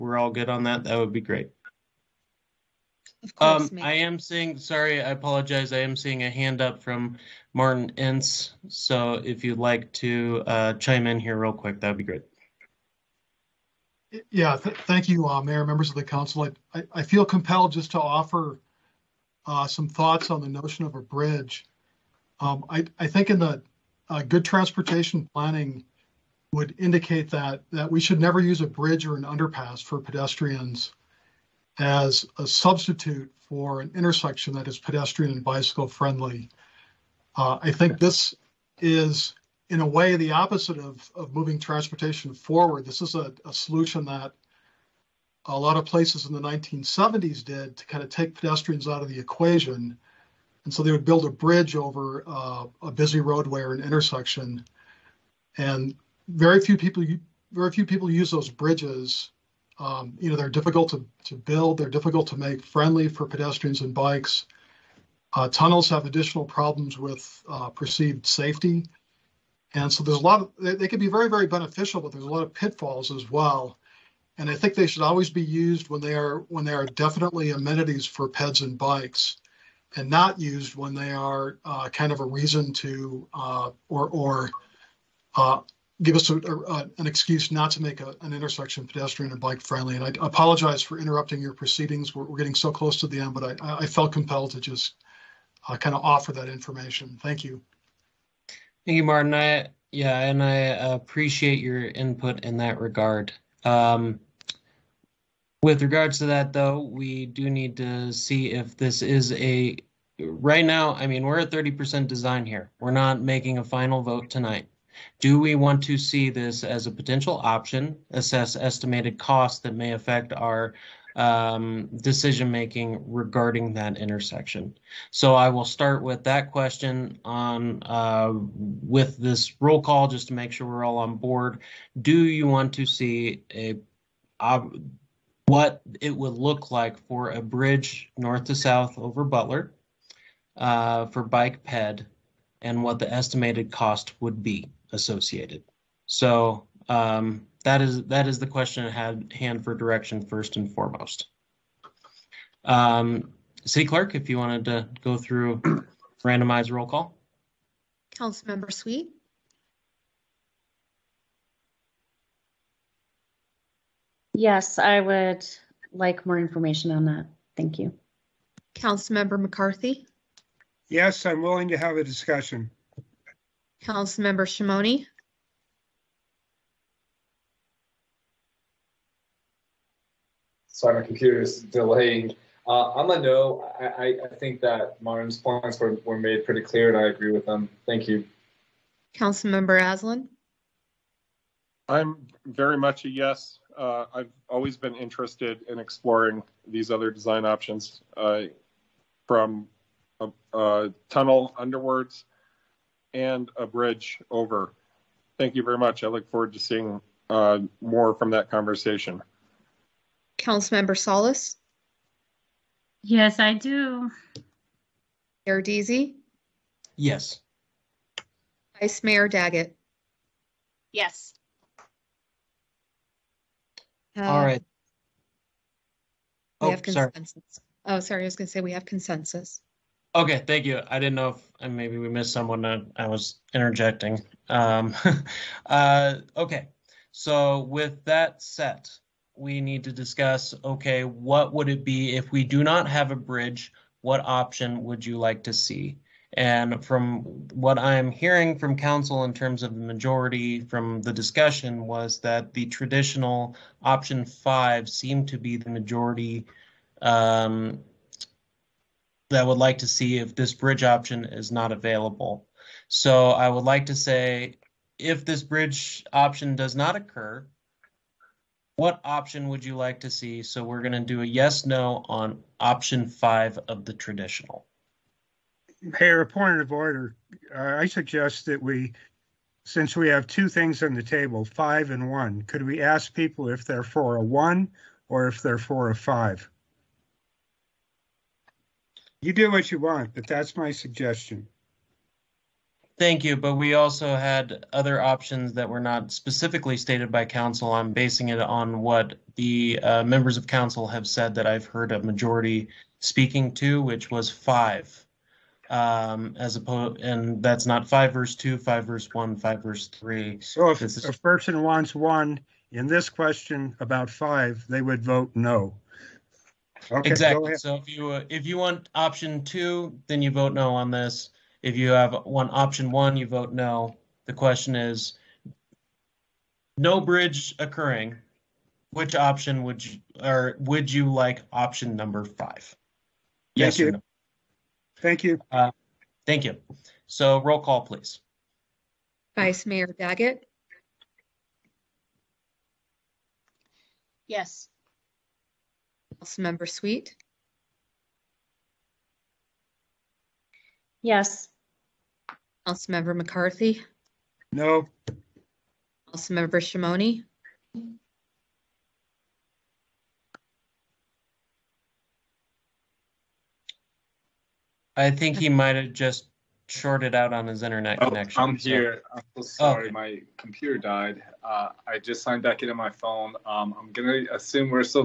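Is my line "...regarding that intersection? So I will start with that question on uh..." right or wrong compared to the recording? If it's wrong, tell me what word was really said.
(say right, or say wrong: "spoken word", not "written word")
right.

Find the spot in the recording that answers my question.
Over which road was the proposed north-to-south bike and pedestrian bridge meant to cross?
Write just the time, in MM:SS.
02:19.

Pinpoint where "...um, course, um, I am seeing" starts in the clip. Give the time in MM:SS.
00:03.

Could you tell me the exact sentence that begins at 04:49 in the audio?
You do what you want, but that's my suggestion.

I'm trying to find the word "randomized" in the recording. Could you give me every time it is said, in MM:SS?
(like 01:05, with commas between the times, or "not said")
02:36.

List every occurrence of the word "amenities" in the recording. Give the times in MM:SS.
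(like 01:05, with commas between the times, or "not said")
01:17.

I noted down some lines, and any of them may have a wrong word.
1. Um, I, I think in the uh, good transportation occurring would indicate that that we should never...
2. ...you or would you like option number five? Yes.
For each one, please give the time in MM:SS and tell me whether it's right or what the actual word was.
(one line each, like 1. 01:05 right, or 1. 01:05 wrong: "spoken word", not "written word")
1. 00:22 wrong: "planning", not "occurring"
2. 05:29 right.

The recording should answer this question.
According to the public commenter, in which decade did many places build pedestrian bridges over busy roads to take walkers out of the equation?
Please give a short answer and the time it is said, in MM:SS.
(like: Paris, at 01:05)
1970s, at 00:46.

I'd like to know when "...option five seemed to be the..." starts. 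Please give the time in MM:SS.
04:13.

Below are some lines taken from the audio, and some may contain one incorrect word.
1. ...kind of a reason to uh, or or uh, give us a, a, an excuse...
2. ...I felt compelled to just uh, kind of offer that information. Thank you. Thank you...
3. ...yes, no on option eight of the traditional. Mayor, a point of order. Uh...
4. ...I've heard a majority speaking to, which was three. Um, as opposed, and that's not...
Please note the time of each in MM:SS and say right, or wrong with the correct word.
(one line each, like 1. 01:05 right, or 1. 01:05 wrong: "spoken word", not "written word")
1. 01:21 right
2. 01:33 right
3. 04:31 wrong: "five", not "eight"
4. 05:01 wrong: "five", not "three".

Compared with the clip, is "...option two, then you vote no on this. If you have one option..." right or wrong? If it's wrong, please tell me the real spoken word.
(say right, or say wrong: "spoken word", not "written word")
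right.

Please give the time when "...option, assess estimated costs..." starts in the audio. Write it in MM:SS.
01:57.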